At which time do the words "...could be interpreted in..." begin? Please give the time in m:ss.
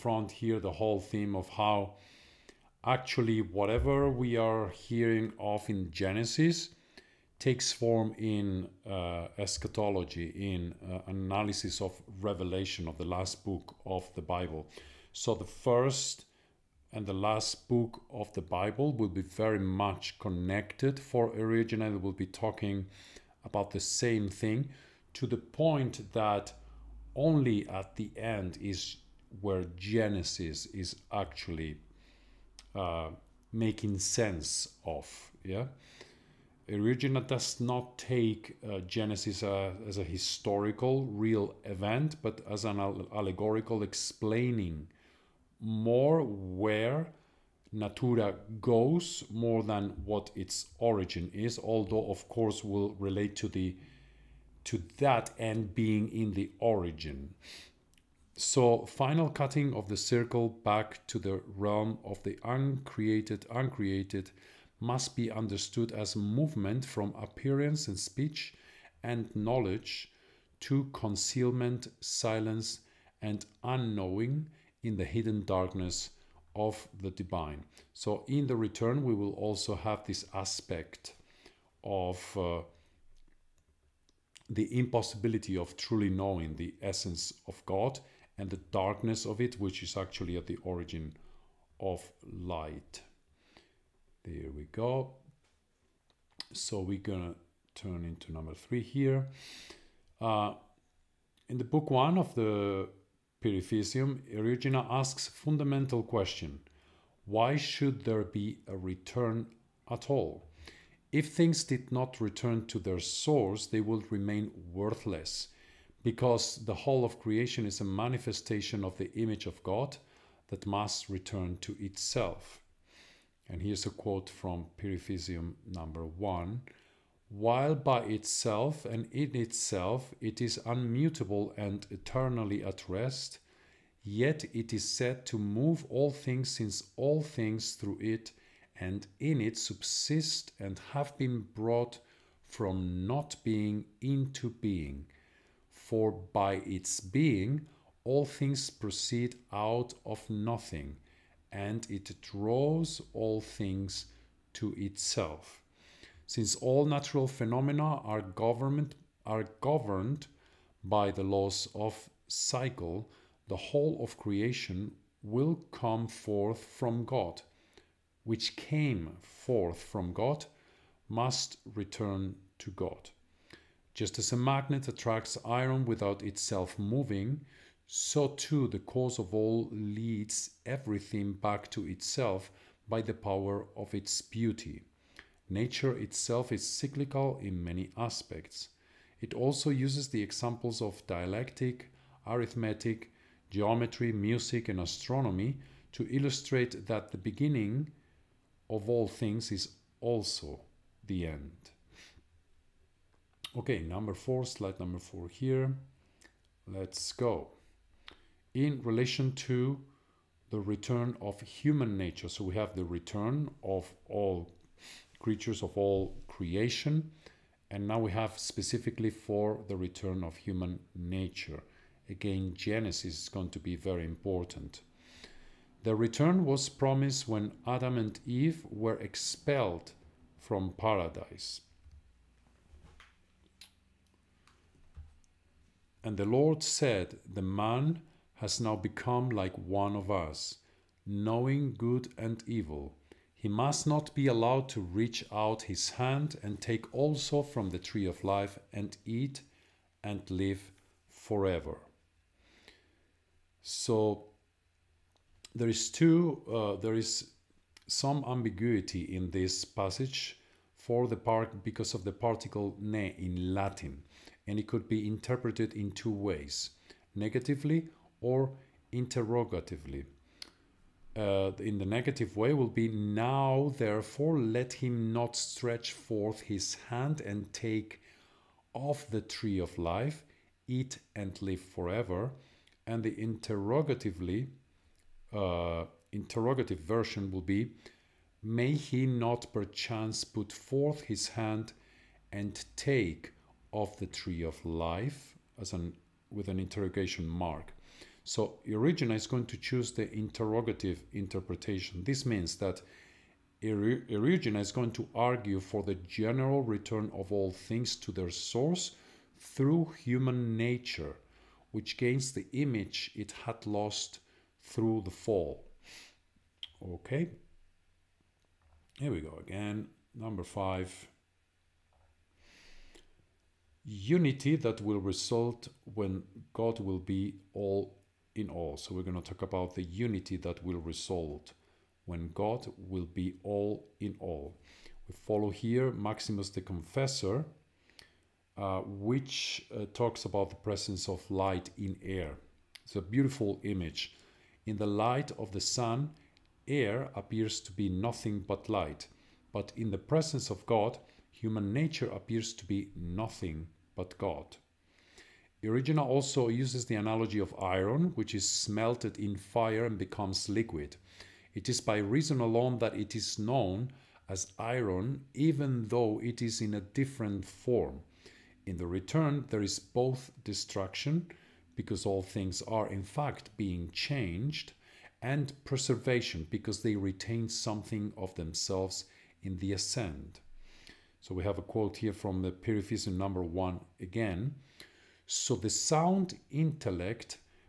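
4:24.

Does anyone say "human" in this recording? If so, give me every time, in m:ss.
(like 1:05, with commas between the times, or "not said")
3:31, 3:40, 5:09, 5:51.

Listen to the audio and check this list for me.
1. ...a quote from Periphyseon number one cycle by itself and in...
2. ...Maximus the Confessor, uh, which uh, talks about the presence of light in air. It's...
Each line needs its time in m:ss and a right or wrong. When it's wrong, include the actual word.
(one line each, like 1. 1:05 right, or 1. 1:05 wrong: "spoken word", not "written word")
1. 2:03 wrong: "while", not "cycle"
2. 5:35 right.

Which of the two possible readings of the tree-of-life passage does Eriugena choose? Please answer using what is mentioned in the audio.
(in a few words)
The interrogative interpretation.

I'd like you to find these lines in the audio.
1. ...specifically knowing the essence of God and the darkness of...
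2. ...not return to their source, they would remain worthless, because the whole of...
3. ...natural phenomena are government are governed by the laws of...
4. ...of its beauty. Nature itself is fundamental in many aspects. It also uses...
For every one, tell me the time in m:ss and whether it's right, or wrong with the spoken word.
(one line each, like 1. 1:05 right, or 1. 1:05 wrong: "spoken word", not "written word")
1. 1:25 wrong: "truly", not "specifically"
2. 1:51 right
3. 2:36 right
4. 3:03 wrong: "cyclical", not "fundamental".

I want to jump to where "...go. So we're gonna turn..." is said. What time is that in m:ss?
1:34.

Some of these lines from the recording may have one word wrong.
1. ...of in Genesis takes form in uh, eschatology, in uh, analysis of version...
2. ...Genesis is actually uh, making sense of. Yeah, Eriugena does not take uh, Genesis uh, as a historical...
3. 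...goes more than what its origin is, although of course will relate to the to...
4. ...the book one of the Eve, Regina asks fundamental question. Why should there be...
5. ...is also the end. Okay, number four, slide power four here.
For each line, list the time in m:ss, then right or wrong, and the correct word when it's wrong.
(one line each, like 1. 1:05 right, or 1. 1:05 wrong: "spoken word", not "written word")
1. 0:05 wrong: "revelation", not "version"
2. 0:29 right
3. 0:48 right
4. 1:41 wrong: "Periphyseon", not "Eve"
5. 3:19 wrong: "number", not "power".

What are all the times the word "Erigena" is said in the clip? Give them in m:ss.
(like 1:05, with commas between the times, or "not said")
4:58, 5:03.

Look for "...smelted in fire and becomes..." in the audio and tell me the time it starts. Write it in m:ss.
5:58.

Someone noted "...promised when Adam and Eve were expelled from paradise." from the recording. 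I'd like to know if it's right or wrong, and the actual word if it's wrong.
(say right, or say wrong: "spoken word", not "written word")
right.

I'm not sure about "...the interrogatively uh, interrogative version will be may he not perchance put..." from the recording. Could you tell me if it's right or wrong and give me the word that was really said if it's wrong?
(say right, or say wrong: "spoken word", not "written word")
right.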